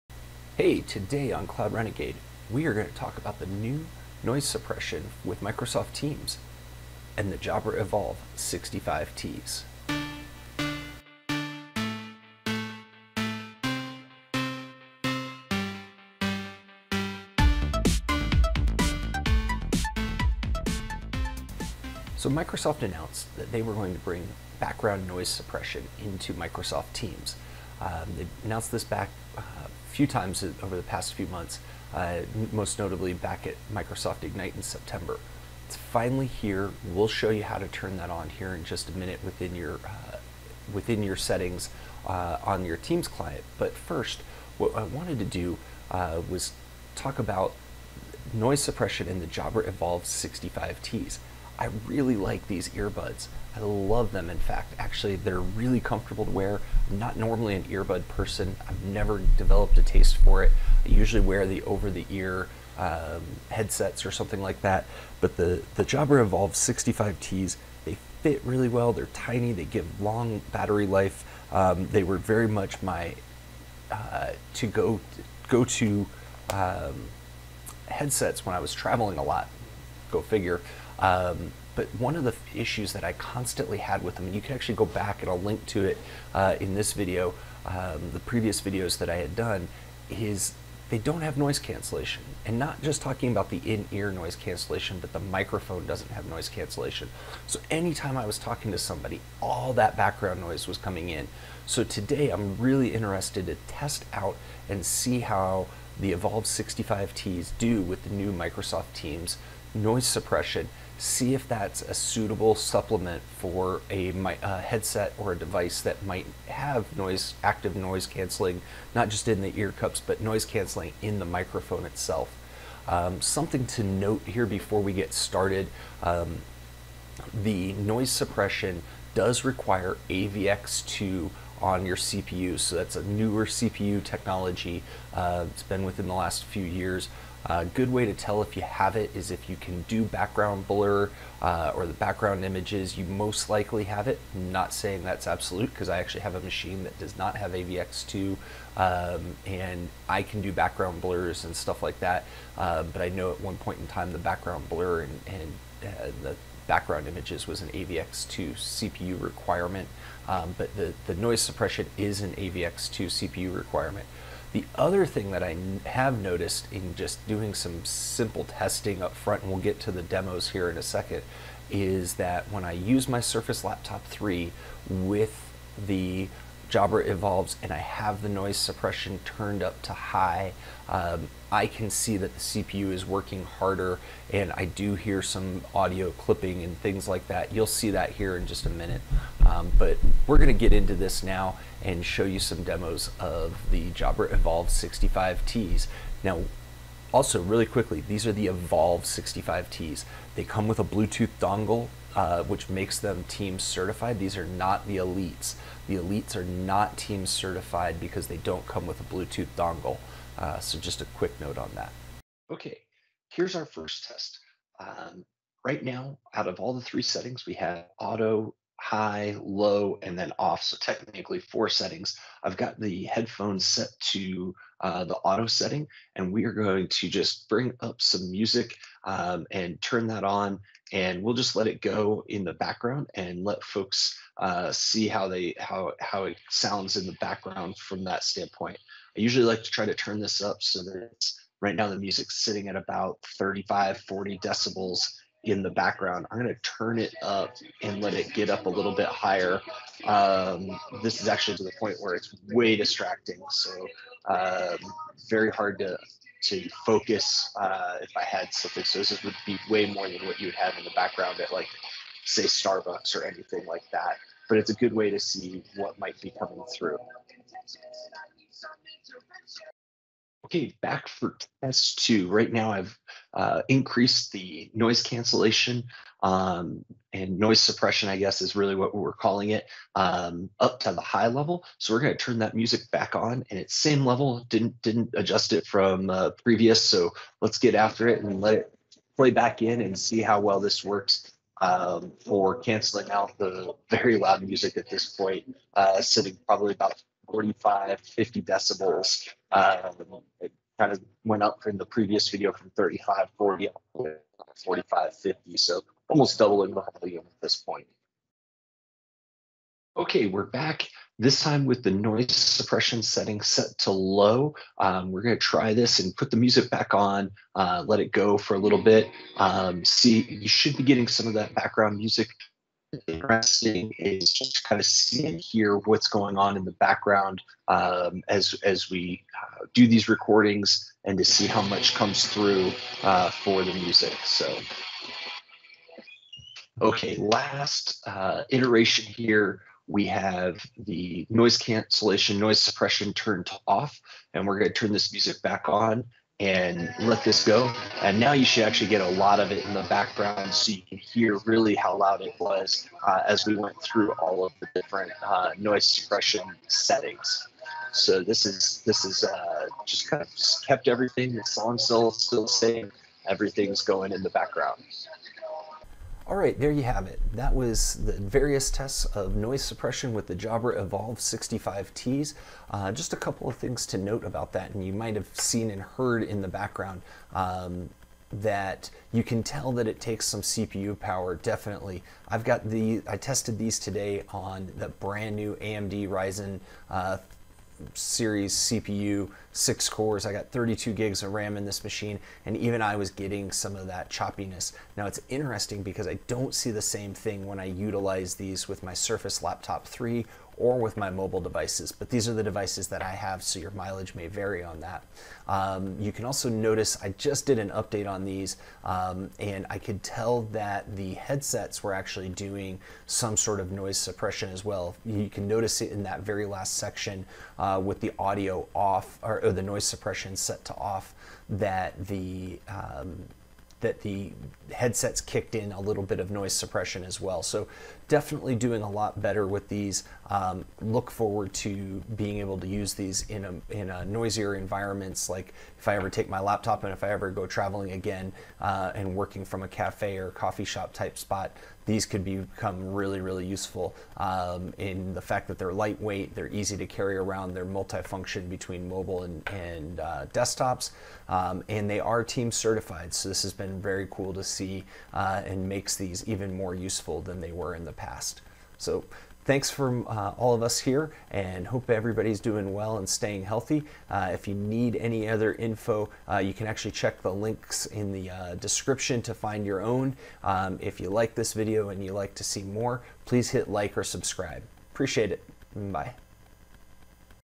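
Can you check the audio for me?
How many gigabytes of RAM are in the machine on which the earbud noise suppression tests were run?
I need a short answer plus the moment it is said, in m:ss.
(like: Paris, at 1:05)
32, at 6:30.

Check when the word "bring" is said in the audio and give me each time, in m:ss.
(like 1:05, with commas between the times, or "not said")
0:24, 3:47.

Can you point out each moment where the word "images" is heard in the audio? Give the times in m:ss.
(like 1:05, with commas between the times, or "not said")
2:22, 2:37.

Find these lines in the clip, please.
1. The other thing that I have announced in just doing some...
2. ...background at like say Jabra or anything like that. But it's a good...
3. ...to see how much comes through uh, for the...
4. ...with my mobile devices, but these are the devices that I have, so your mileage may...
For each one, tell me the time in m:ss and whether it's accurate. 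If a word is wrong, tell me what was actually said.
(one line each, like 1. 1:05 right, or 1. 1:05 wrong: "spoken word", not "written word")
1. 2:44 wrong: "noticed", not "announced"
2. 4:20 wrong: "Starbucks", not "Jabra"
3. 5:31 right
4. 6:40 right.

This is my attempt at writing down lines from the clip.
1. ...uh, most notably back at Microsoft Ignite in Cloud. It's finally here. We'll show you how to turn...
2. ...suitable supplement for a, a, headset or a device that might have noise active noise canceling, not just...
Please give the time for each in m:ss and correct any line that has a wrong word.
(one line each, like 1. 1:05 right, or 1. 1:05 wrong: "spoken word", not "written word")
1. 0:31 wrong: "September", not "Cloud"
2. 1:51 right.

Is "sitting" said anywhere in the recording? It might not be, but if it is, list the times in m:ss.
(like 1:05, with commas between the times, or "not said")
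4:02, 4:56.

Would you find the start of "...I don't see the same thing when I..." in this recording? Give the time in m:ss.
6:36.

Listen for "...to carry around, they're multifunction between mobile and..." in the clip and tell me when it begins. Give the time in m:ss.
7:26.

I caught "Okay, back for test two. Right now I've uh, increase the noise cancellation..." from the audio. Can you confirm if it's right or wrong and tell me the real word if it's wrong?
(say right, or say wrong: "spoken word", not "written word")
right.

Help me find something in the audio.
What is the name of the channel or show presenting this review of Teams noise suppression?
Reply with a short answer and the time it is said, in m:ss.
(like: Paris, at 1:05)
Cloud Renegade, at 0:01.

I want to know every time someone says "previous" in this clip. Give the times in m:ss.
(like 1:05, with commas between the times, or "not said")
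1:28, 4:46, 5:01.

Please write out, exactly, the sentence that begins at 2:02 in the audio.
Um, something to note here before we get started, um, the noise suppression does require avx to on your CPU.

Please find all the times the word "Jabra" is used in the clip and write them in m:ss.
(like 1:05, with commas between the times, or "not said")
0:07, 0:49, 1:05, 2:56, 3:13, 6:10.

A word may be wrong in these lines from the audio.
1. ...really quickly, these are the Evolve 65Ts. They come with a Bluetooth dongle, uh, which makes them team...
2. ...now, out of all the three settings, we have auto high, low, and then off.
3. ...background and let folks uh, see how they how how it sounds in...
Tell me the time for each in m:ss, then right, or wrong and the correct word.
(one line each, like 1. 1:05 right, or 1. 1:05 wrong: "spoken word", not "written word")
1. 3:17 right
2. 3:35 right
3. 3:52 right.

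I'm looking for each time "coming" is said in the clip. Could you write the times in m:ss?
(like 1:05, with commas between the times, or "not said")
1:40, 4:26.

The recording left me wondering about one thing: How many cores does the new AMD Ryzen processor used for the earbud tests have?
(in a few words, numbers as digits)
6.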